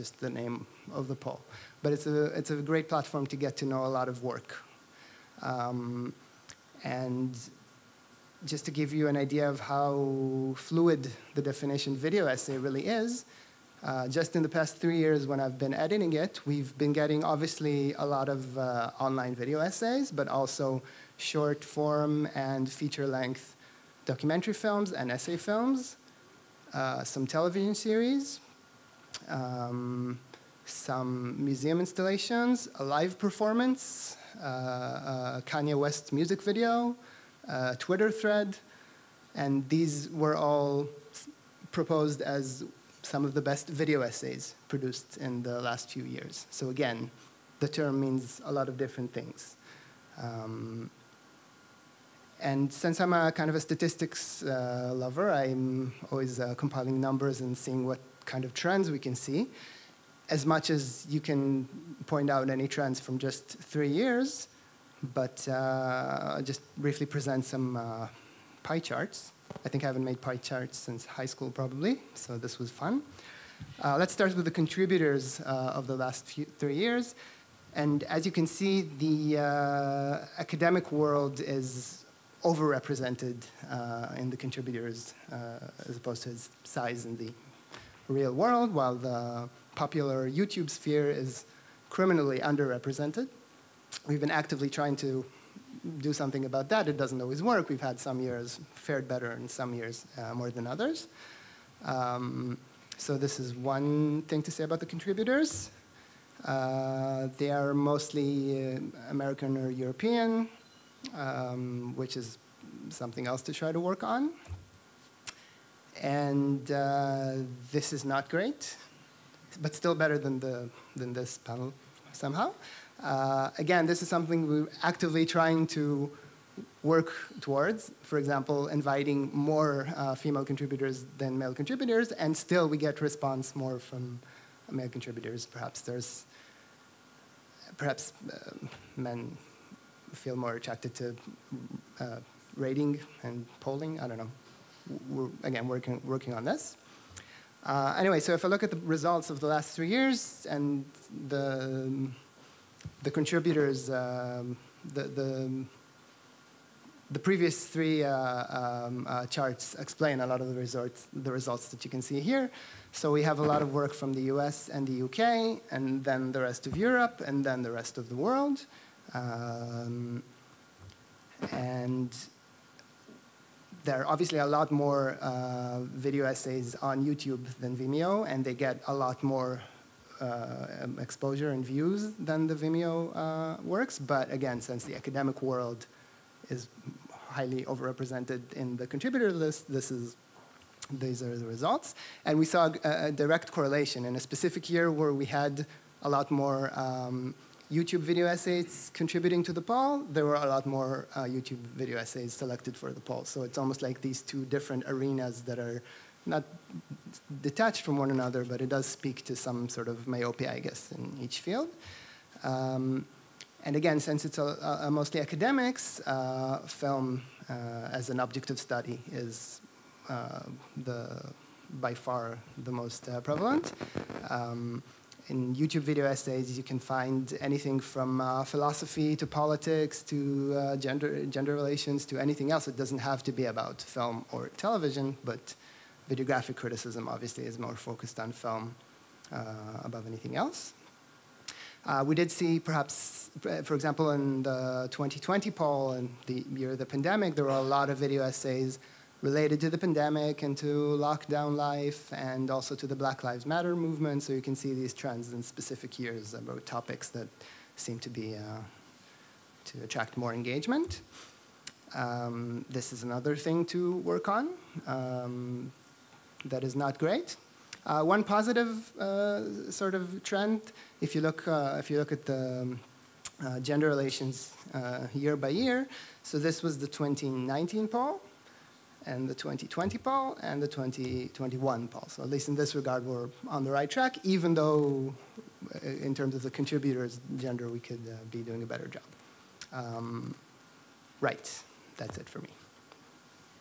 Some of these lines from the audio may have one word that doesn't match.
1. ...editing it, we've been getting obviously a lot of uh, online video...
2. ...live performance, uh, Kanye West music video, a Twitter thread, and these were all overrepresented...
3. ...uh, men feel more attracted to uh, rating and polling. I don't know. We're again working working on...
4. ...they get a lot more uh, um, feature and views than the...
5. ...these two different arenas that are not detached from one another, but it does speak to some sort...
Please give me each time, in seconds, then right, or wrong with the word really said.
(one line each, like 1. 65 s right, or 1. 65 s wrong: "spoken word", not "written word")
1. 15 s right
2. 32 s wrong: "proposed", not "overrepresented"
3. 138 s right
4. 178 s wrong: "exposure", not "feature"
5. 204 s right.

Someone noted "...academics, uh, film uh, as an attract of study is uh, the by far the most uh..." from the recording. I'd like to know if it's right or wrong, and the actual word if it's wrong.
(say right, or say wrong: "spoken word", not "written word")
wrong: "object", not "attract".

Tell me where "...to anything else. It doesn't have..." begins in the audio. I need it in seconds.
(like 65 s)
232 s.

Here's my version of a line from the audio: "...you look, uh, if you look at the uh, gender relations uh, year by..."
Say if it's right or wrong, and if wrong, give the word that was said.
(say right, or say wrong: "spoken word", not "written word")
right.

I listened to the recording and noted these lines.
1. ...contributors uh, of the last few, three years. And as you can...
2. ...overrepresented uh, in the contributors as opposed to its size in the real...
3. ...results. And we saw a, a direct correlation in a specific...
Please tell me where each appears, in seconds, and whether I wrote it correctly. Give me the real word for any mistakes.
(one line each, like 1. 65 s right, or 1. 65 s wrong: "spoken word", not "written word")
1. 74 s right
2. 82 s right
3. 191 s right.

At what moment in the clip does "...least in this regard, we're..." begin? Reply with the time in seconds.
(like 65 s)
282 s.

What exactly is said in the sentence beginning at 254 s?
So you can see these trends in specific years about topics that seem to be uh, to attract more engagement.